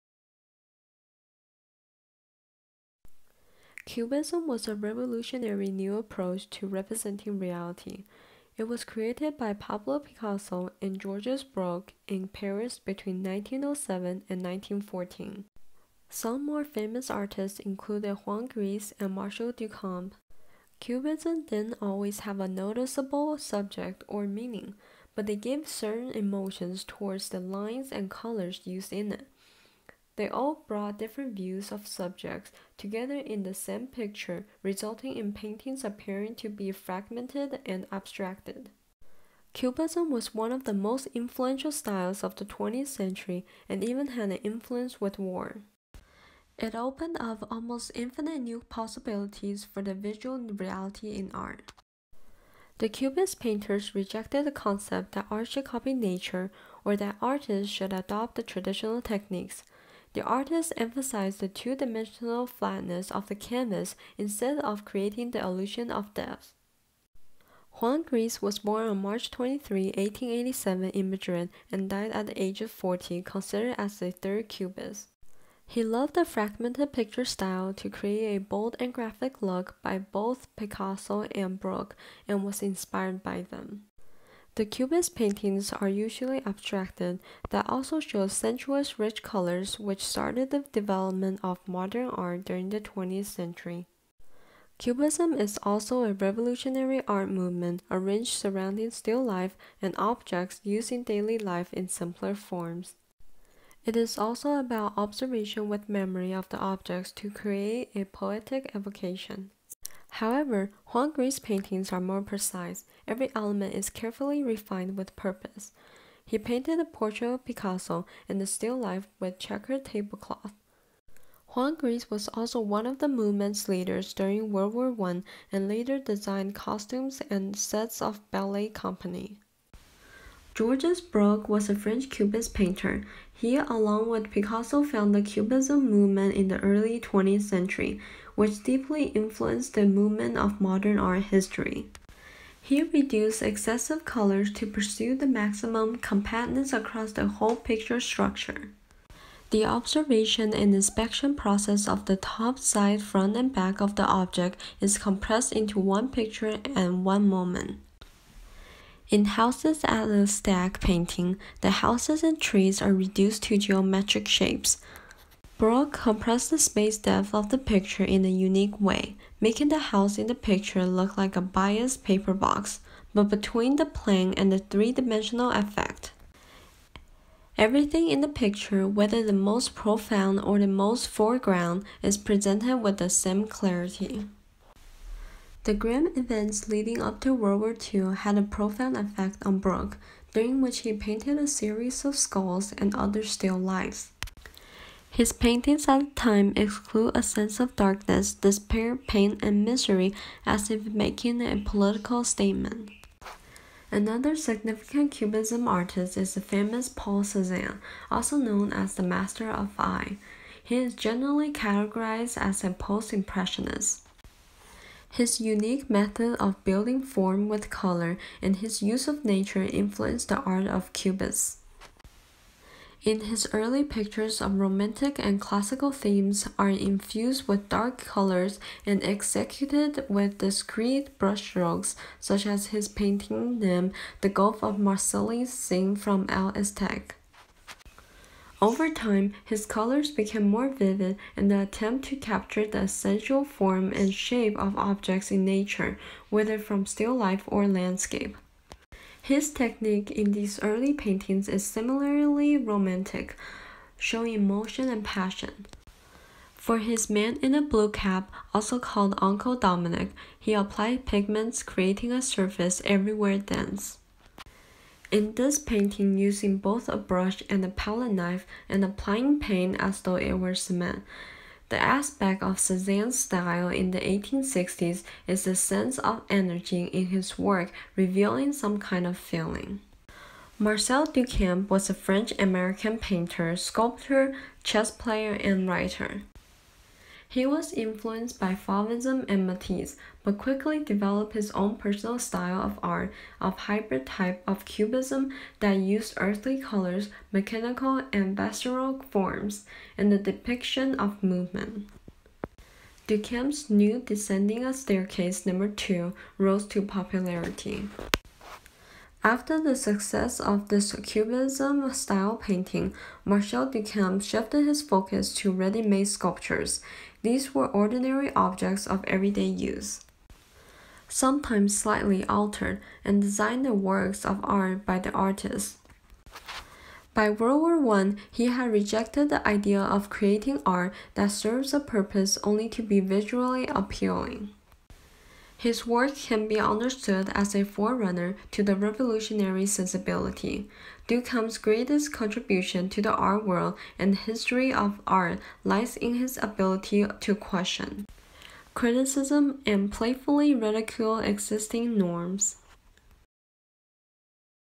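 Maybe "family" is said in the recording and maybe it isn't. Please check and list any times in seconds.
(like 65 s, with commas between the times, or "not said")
not said.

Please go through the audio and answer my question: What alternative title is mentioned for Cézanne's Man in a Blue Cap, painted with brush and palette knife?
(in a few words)
Uncle Dominic.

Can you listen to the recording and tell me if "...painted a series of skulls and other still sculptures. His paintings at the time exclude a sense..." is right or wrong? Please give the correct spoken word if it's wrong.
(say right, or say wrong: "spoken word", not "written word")
wrong: "lifes", not "sculptures".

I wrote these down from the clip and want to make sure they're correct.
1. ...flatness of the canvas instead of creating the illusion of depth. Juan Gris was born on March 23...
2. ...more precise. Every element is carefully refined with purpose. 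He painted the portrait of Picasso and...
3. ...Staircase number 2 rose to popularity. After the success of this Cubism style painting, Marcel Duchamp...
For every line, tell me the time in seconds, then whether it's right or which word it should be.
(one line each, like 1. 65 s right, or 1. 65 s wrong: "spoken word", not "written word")
1. 62 s right
2. 112 s right
3. 304 s right.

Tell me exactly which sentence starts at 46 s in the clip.
It opened up almost infinite new possibilities for the visual reality in art.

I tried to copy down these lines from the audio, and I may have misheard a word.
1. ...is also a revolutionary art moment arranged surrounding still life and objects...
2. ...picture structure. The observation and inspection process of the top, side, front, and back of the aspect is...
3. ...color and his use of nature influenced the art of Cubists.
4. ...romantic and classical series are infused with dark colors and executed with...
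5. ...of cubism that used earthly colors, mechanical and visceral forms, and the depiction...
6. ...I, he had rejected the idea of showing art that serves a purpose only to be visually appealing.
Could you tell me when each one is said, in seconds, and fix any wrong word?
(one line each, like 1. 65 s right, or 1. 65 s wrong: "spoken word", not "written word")
1. 95 s wrong: "movement", not "moment"
2. 147 s wrong: "object", not "aspect"
3. 217 s right
4. 224 s wrong: "themes", not "series"
5. 294 s right
6. 327 s wrong: "creating", not "showing".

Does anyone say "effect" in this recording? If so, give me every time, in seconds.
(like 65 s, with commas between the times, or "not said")
175 s, 188 s.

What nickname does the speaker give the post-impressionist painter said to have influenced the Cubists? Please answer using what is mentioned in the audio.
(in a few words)
Master of Eye.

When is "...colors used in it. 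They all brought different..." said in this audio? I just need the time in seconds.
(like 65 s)
28 s.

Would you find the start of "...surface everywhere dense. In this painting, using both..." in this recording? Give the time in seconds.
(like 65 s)
262 s.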